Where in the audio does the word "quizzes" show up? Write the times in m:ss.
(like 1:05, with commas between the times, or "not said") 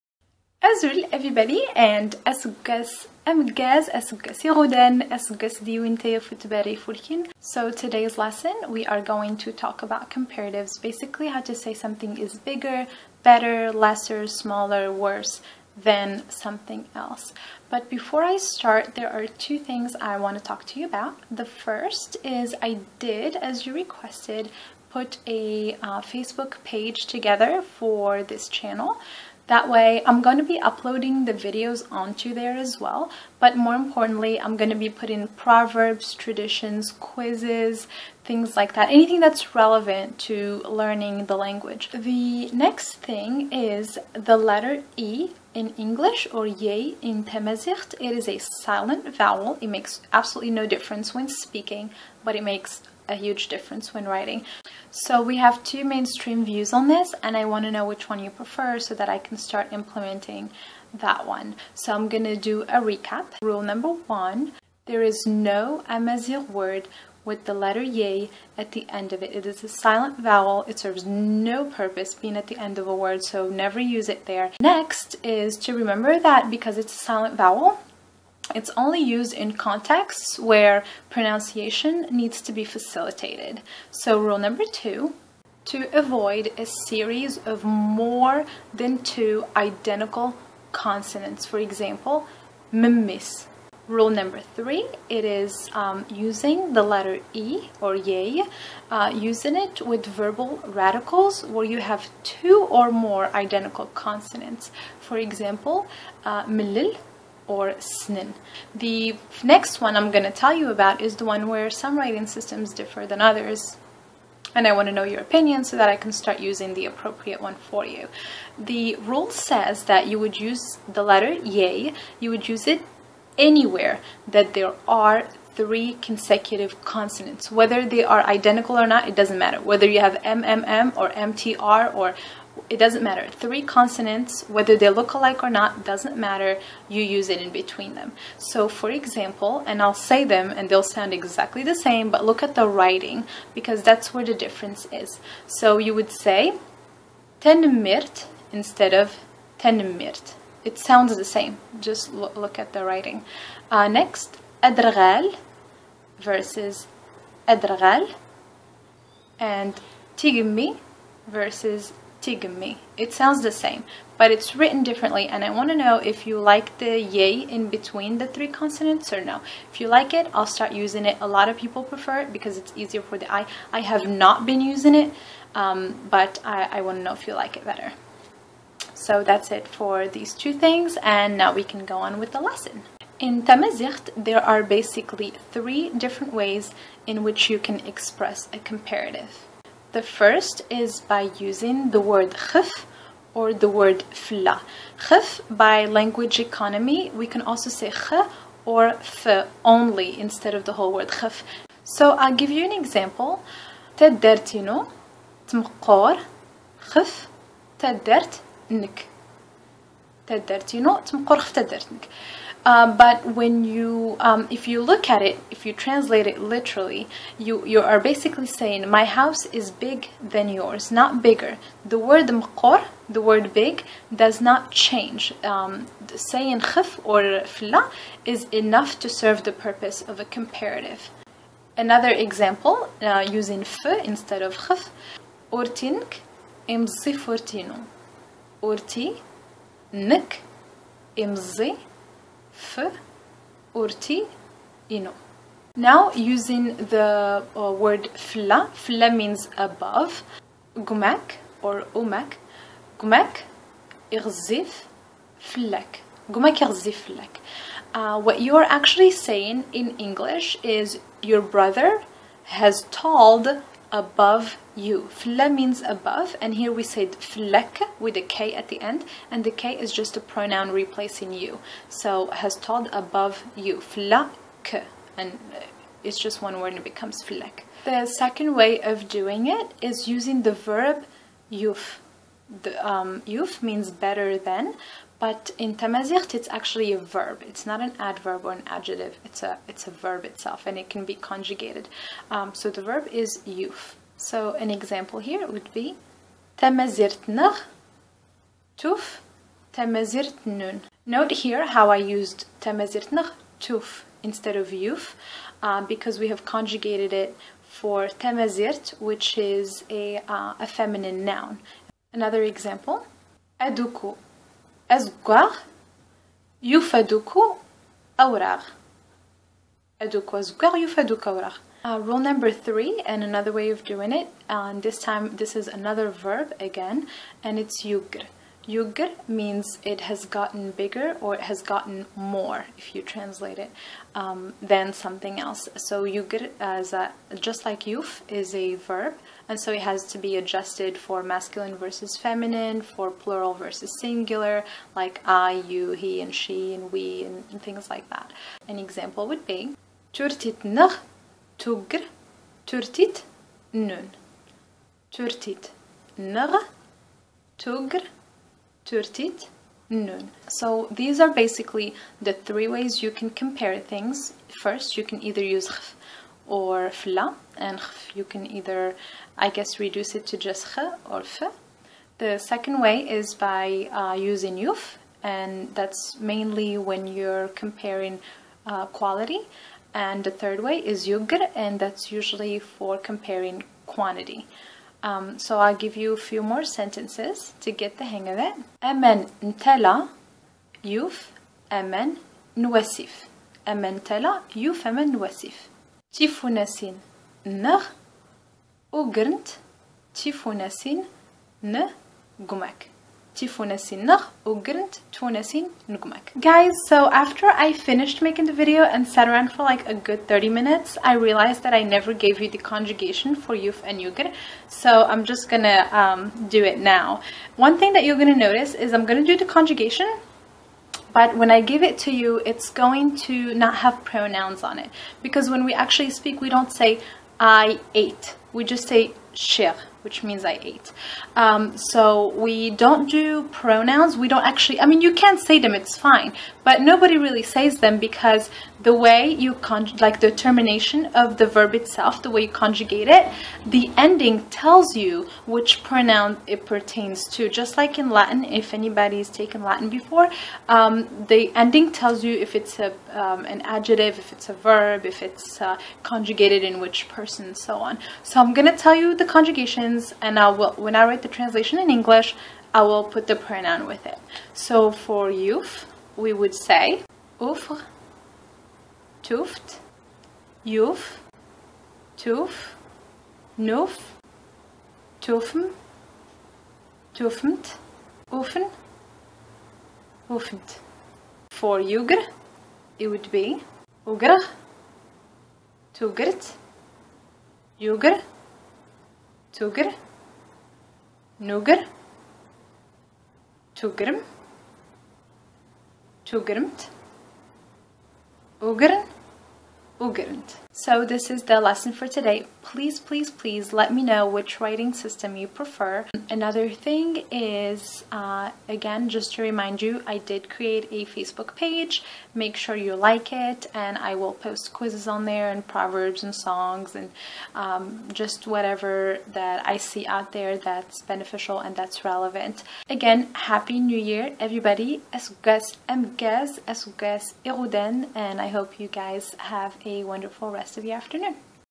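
0:36, 8:34.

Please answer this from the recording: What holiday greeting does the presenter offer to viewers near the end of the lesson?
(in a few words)
Happy New Year.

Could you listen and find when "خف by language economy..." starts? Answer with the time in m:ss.
3:15.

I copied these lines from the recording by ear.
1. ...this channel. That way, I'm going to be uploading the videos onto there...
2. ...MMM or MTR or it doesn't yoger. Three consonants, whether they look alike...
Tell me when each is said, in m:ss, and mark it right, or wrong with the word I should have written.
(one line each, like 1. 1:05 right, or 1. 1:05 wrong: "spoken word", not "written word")
1. 0:28 right
2. 2:10 wrong: "matter", not "yoger".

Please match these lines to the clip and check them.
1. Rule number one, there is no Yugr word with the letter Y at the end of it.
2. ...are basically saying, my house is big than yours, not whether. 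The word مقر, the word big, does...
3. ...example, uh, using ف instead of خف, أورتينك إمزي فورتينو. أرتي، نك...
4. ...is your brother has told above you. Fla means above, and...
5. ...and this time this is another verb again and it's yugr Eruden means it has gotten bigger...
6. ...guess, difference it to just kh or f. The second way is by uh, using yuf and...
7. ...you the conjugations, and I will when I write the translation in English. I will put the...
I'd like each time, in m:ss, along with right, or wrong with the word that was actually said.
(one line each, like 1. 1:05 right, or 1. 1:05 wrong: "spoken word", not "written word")
1. 1:03 wrong: "Amazigh", not "Yugr"
2. 3:37 wrong: "bigger", not "whether"
3. 3:52 right
4. 4:20 right
5. 5:24 wrong: "Yugr", not "Eruden"
6. 6:09 wrong: "reduce", not "difference"
7. 7:38 right.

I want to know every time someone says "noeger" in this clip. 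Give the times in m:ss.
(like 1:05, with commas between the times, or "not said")
8:11.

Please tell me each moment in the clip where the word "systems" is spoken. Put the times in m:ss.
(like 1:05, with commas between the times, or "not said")
1:52, 8:24.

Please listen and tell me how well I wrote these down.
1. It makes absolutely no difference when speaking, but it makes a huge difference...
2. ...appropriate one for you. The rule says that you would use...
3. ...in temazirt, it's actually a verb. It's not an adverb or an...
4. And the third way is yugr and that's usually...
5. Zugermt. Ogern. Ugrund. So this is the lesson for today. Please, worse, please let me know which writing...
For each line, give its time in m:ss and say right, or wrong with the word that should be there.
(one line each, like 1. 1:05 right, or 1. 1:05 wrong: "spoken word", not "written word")
1. 0:49 right
2. 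1:56 right
3. 4:45 right
4. 6:19 right
5. 8:16 wrong: "please", not "worse".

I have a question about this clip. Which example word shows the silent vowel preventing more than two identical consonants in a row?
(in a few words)
mimis.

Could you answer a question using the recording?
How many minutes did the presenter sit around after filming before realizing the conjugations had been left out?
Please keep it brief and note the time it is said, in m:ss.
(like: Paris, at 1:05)
30, at 6:50.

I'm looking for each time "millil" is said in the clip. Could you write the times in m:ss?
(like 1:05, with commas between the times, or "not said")
1:46.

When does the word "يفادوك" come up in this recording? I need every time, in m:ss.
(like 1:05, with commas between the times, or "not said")
5:16, 5:20.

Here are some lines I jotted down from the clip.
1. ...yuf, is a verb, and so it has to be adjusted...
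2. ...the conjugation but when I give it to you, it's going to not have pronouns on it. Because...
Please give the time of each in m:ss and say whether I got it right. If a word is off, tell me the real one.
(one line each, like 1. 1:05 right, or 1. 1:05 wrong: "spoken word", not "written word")
1. 5:37 right
2. 6:59 right.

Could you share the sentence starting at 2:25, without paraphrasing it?
So you would say tenmirt instead of tenmirt.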